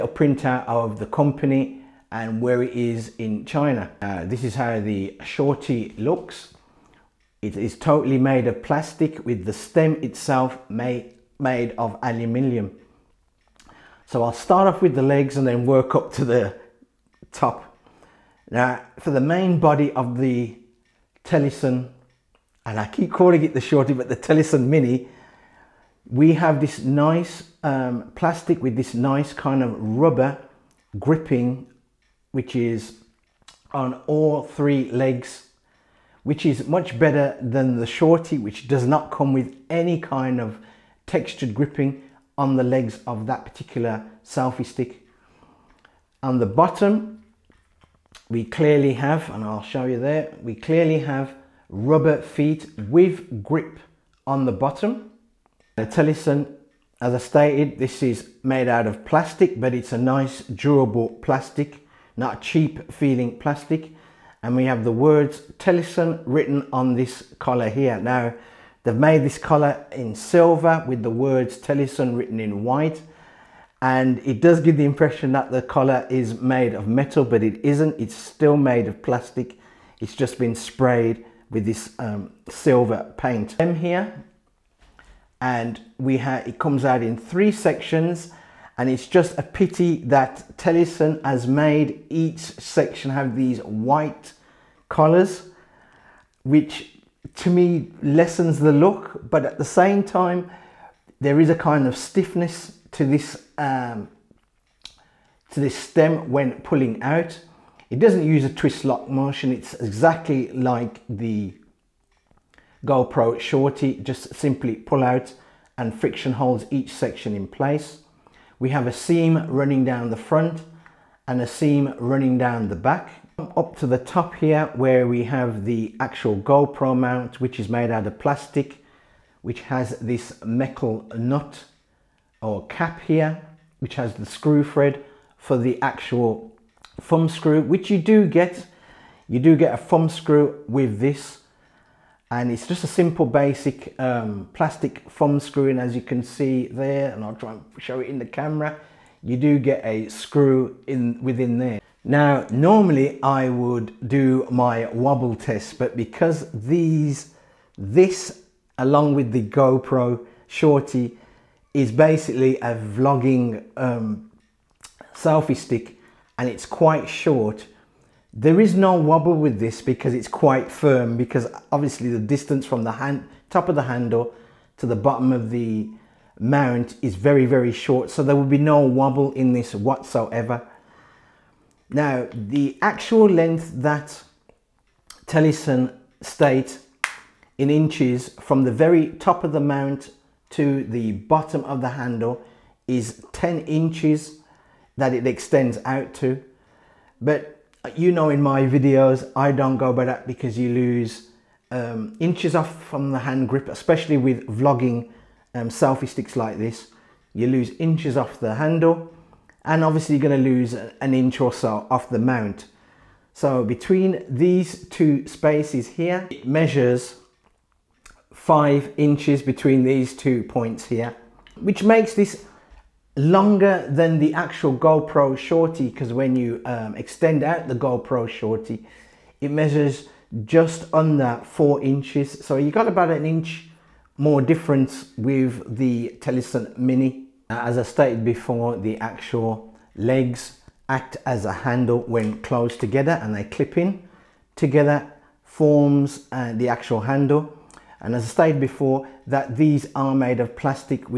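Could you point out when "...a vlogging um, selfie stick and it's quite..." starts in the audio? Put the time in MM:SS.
02:42.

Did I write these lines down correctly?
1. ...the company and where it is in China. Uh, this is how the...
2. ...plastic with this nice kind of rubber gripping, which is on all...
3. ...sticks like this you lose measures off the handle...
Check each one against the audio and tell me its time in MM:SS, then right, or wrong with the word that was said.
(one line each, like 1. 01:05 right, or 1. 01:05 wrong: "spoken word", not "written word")
1. 00:00 right
2. 00:28 right
3. 03:26 wrong: "inches", not "measures".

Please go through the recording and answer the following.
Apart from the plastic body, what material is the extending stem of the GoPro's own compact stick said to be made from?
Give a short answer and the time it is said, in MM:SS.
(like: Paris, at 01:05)
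aluminium, at 00:12.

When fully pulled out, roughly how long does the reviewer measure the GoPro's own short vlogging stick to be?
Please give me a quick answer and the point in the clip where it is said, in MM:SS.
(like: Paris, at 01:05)
just under 4 inches, at 03:50.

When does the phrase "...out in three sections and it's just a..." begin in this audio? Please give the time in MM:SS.
01:26.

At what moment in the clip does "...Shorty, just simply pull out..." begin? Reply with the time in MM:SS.
01:53.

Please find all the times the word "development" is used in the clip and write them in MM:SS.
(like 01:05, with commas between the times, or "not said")
not said.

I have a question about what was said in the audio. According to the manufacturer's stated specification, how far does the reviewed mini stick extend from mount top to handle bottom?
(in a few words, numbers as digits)
10 inches.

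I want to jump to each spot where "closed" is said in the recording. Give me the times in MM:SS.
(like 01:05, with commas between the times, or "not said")
04:02.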